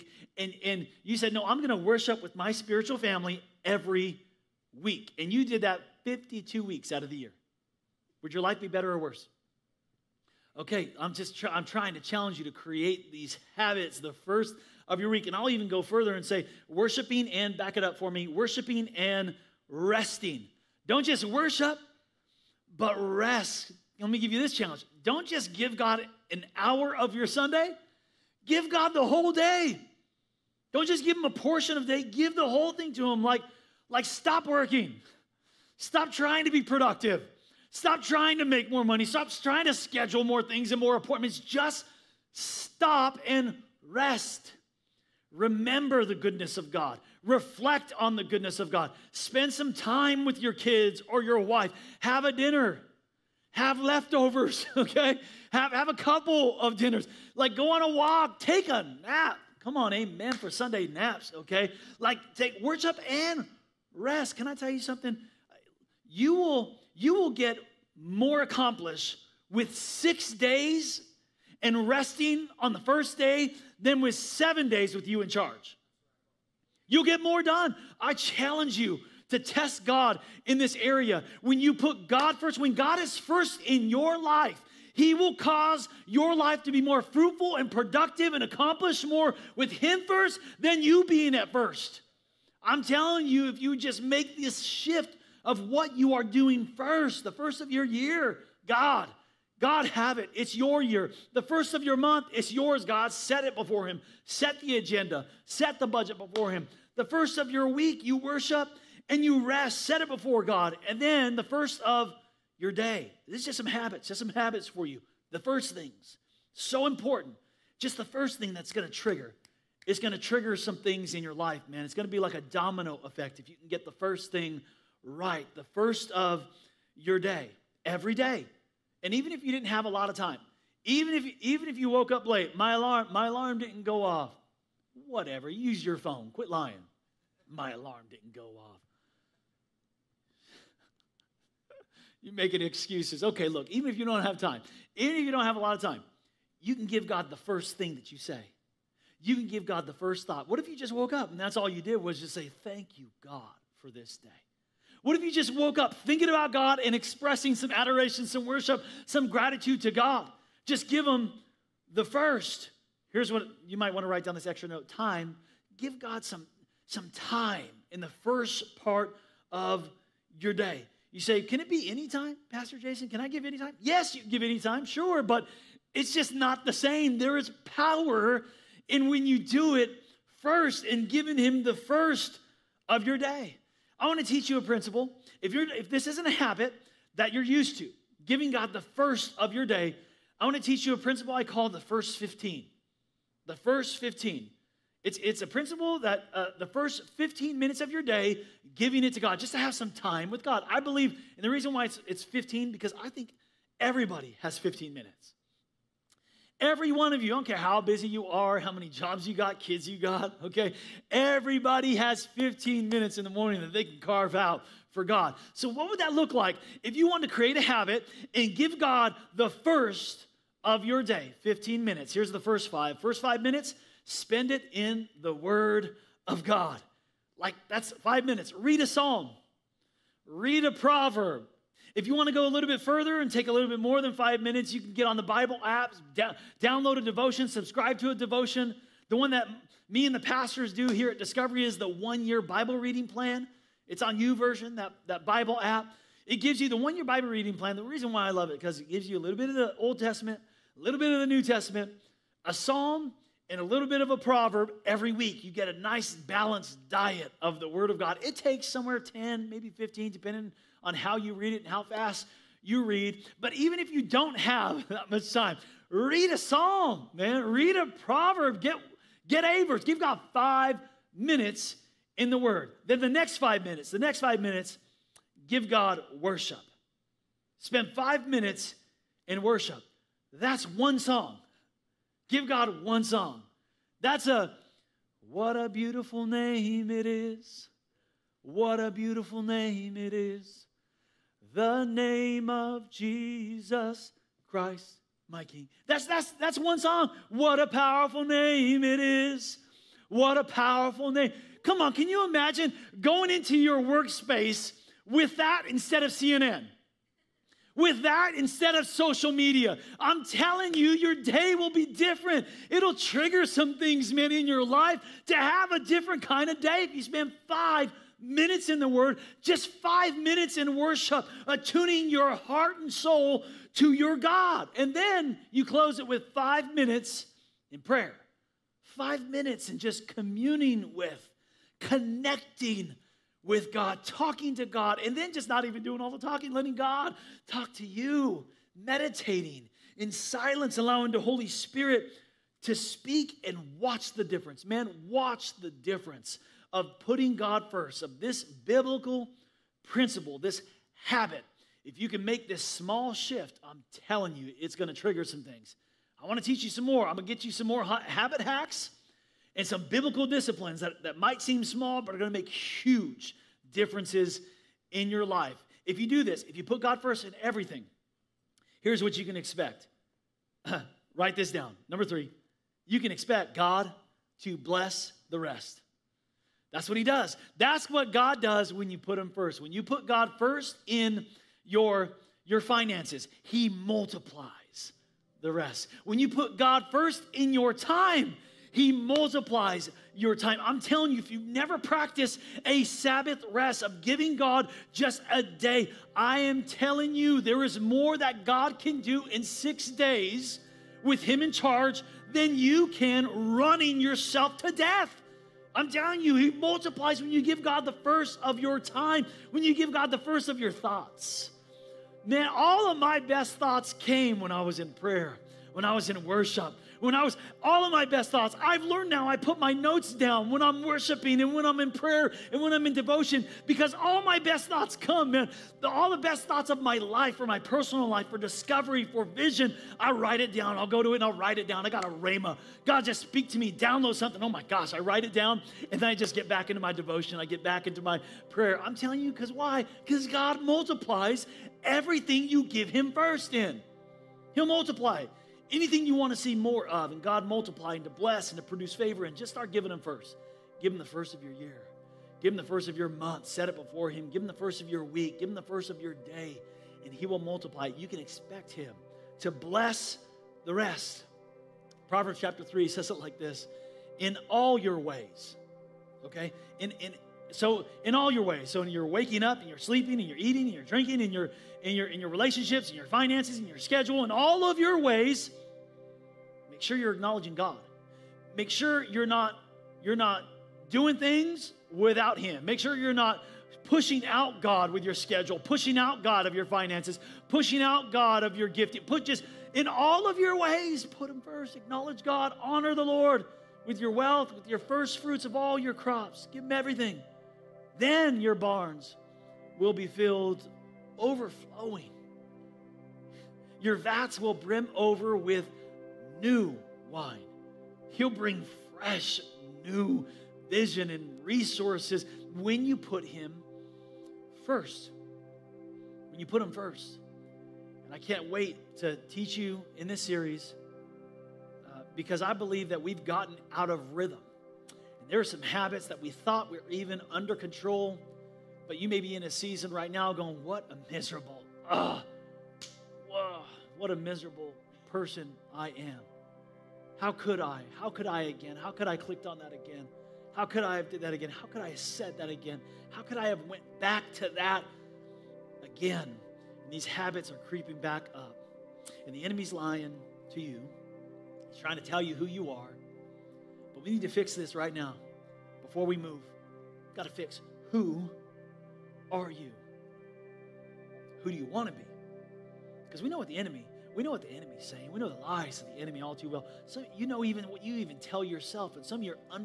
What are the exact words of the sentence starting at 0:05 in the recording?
And you did that 52 weeks out of the year.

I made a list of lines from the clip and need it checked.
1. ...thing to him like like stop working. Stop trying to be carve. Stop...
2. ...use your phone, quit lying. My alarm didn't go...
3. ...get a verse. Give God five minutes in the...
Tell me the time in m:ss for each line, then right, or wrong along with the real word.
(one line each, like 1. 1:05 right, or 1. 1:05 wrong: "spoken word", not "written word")
1. 0:32 wrong: "productive", not "carve"
2. 2:15 right
3. 4:29 right.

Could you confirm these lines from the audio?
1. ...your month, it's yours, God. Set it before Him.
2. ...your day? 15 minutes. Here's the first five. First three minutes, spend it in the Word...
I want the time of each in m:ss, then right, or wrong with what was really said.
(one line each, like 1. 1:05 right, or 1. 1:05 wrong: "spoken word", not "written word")
1. 1:41 right
2. 3:40 wrong: "five", not "three".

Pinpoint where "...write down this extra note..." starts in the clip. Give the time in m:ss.
2:44.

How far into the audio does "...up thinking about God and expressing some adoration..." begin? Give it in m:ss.
2:35.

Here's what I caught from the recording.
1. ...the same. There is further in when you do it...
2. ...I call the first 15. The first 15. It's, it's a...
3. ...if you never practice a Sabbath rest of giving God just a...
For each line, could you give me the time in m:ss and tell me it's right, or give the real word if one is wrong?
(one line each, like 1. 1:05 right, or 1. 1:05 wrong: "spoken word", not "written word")
1. 2:56 wrong: "power", not "further"
2. 3:11 right
3. 6:31 right.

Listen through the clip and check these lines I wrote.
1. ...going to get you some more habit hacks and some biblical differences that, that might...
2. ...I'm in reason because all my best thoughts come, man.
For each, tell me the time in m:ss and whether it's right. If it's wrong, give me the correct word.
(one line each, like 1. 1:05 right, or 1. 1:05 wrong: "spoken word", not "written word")
1. 5:57 wrong: "disciplines", not "differences"
2. 7:02 wrong: "devotion", not "reason".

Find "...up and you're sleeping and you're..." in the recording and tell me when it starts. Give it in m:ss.
7:49.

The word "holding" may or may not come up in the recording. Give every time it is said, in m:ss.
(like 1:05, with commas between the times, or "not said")
not said.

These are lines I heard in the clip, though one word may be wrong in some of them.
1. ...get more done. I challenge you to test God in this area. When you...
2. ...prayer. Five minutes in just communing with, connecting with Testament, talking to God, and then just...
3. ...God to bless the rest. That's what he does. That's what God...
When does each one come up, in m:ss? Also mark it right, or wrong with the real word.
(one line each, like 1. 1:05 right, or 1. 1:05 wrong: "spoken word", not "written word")
1. 1:17 right
2. 5:27 wrong: "God", not "Testament"
3. 6:13 right.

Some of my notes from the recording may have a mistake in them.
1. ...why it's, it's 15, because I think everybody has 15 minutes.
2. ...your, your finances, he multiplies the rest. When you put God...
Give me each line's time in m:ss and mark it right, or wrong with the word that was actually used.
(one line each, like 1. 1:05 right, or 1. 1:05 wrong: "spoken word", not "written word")
1. 3:21 right
2. 6:21 right.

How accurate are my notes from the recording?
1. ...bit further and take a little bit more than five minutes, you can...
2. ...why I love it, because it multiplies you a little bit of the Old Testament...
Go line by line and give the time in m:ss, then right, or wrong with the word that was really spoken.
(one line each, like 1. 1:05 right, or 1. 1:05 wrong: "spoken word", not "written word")
1. 3:52 right
2. 4:08 wrong: "gives", not "multiplies".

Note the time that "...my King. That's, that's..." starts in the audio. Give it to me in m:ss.
4:55.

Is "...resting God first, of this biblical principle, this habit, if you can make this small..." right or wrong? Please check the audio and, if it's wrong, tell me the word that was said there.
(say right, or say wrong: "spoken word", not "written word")
wrong: "putting", not "resting".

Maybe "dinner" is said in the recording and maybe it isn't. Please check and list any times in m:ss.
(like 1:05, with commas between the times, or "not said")
0:52, 0:56.